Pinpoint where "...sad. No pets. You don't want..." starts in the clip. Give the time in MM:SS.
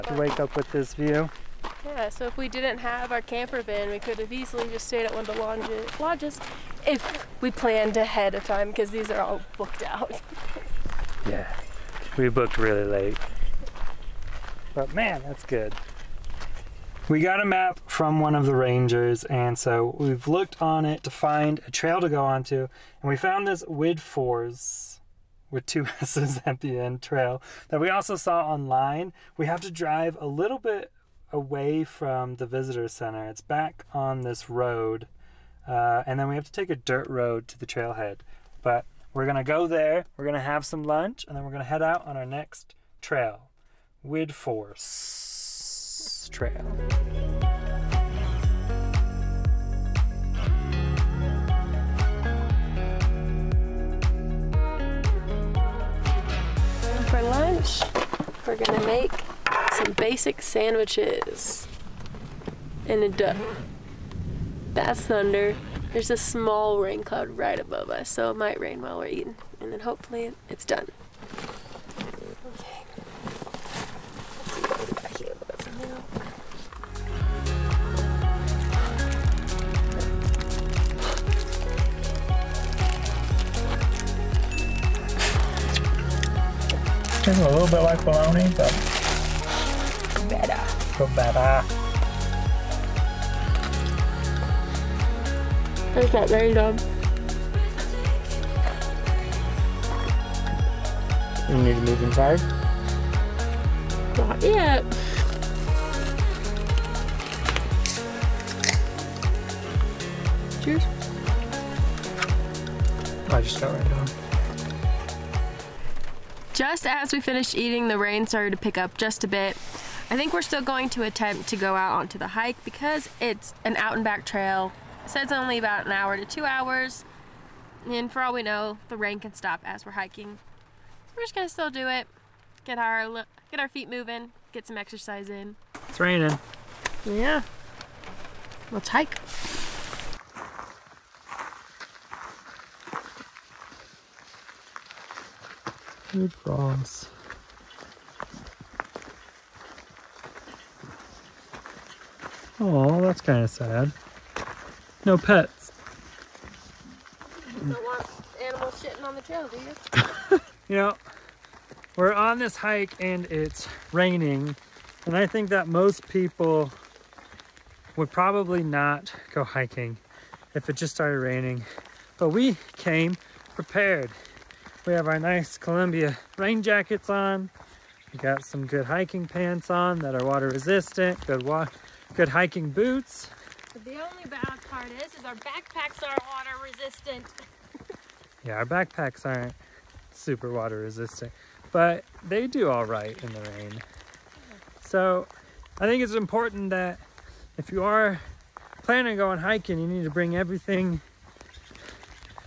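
02:33.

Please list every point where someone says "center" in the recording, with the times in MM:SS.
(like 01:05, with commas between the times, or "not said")
00:32.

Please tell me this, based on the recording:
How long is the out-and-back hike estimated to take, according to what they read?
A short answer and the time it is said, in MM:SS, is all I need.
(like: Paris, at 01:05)
1 to 2 hours, at 02:05.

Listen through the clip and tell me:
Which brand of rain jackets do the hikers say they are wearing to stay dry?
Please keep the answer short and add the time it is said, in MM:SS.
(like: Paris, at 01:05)
Columbia, at 02:55.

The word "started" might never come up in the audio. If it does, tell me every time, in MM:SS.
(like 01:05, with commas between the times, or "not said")
01:58, 02:50.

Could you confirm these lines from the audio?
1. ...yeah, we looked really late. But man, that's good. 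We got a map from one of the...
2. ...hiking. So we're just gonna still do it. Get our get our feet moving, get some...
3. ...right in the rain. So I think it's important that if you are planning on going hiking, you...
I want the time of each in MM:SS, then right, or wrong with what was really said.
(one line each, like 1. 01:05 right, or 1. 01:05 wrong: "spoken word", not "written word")
1. 00:11 wrong: "booked", not "looked"
2. 02:09 right
3. 03:12 right.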